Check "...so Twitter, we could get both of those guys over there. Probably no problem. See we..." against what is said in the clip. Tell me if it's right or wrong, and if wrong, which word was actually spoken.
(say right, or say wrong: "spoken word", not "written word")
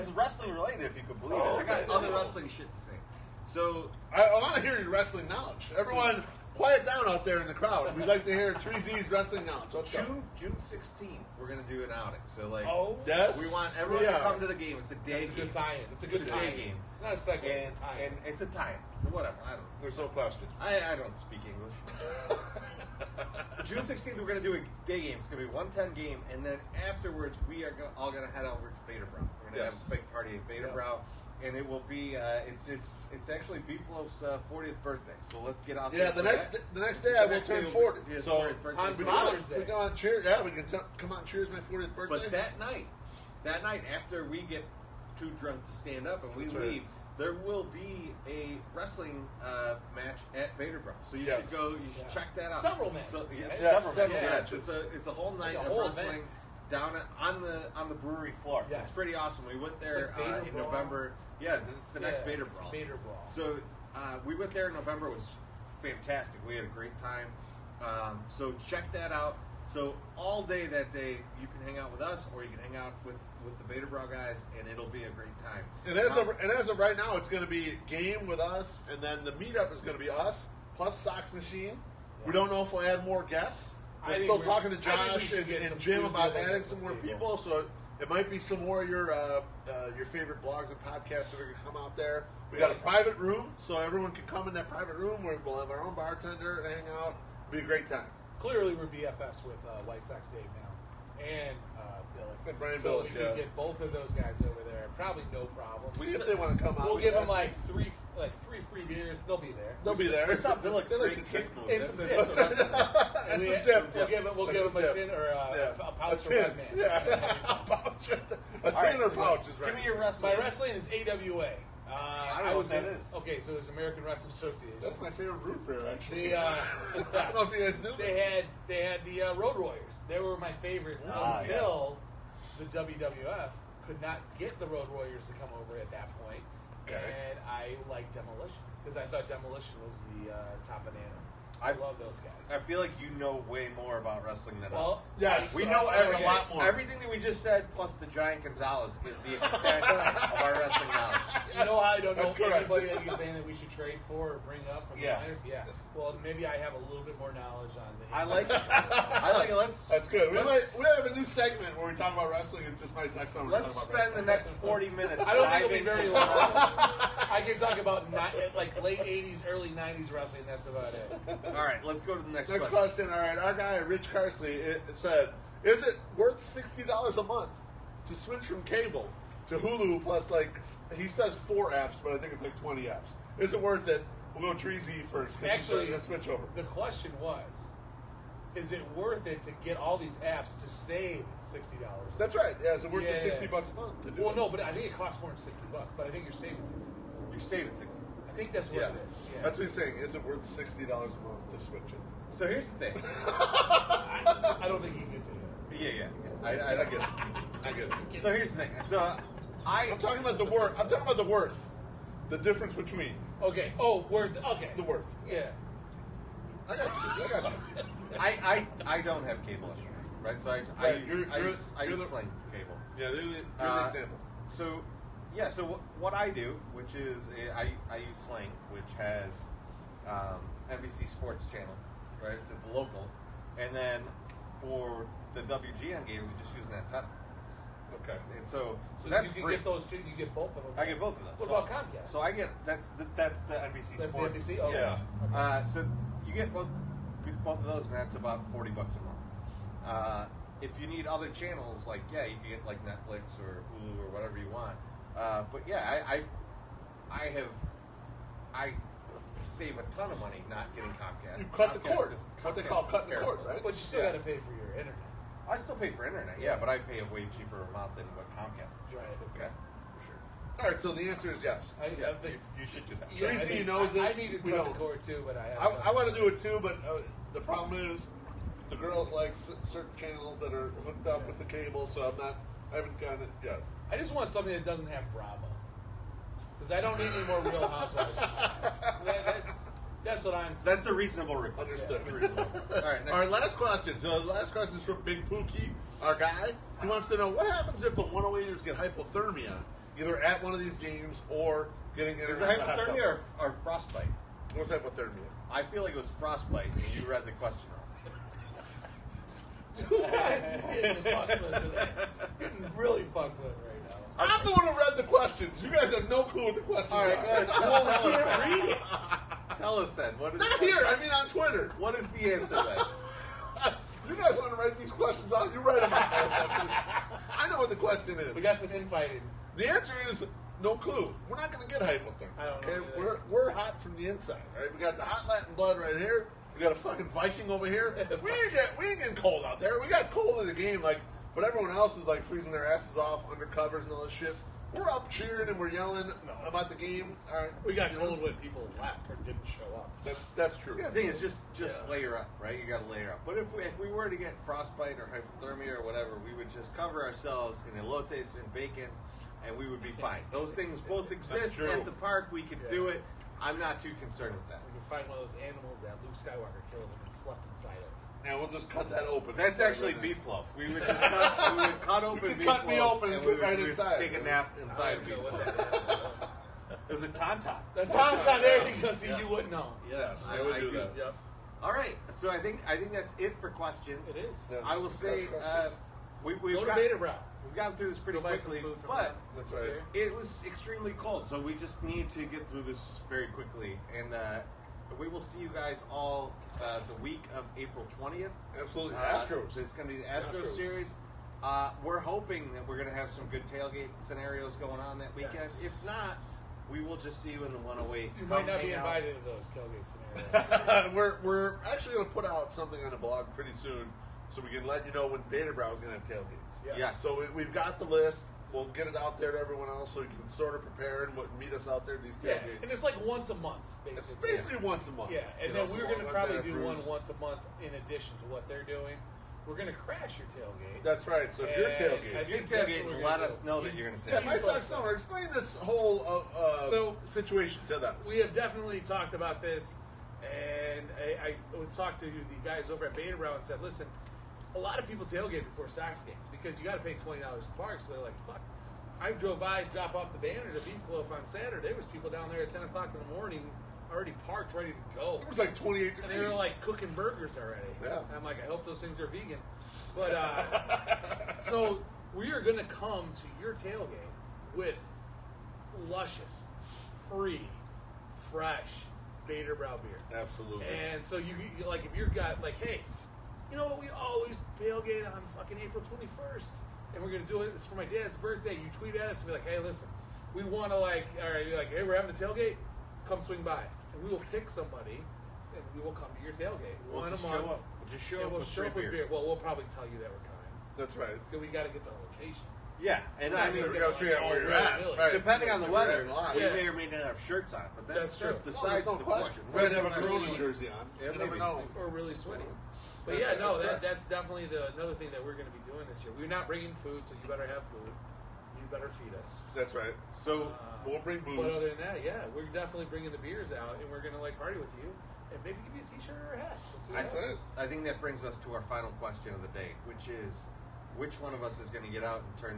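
wrong: "Billick", not "Twitter".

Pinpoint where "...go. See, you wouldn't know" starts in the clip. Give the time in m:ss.
6:18.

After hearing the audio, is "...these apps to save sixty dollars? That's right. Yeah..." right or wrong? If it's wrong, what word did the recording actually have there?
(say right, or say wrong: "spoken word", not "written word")
right.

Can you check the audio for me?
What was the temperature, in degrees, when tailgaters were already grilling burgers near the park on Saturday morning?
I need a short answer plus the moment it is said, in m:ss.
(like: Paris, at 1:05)
28, at 7:35.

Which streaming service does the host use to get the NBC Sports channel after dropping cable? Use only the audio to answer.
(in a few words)
Sling.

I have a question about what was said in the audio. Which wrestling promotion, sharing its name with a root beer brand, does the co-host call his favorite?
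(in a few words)
AWA.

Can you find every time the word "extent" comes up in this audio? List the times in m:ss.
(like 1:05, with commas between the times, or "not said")
2:29.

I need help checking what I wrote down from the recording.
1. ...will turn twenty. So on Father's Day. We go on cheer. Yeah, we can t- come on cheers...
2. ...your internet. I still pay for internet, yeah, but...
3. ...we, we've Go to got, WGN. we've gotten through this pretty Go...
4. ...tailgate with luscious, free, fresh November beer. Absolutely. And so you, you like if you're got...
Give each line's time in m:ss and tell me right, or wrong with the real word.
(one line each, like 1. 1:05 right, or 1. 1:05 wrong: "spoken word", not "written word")
1. 0:37 wrong: "forty", not "twenty"
2. 4:24 right
3. 6:26 wrong: "Baderbrau", not "WGN"
4. 7:43 wrong: "Baderbrau", not "November".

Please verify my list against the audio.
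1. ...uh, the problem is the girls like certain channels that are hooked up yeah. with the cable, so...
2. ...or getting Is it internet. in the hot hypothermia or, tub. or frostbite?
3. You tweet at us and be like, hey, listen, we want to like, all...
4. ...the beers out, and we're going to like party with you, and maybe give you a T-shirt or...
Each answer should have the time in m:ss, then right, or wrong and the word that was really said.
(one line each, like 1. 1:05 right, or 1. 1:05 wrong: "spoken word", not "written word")
1. 4:36 right
2. 5:01 right
3. 7:58 right
4. 8:33 right.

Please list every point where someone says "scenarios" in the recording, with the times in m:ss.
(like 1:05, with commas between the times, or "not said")
6:43, 6:50.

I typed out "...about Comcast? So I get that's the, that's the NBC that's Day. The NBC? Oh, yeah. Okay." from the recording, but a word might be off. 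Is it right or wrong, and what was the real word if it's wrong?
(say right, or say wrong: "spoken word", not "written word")
wrong: "Sports", not "Day".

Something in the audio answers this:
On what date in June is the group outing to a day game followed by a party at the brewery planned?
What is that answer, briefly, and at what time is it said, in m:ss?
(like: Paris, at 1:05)
June 16, at 0:10.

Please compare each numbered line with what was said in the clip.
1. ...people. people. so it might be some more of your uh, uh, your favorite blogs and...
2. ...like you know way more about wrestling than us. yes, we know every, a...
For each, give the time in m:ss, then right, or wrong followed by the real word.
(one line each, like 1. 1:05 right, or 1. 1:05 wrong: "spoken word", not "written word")
1. 1:26 right
2. 2:22 right.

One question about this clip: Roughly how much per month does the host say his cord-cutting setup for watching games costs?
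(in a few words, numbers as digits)
40 dollars.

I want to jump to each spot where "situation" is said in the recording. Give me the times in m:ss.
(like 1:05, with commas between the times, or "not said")
7:17.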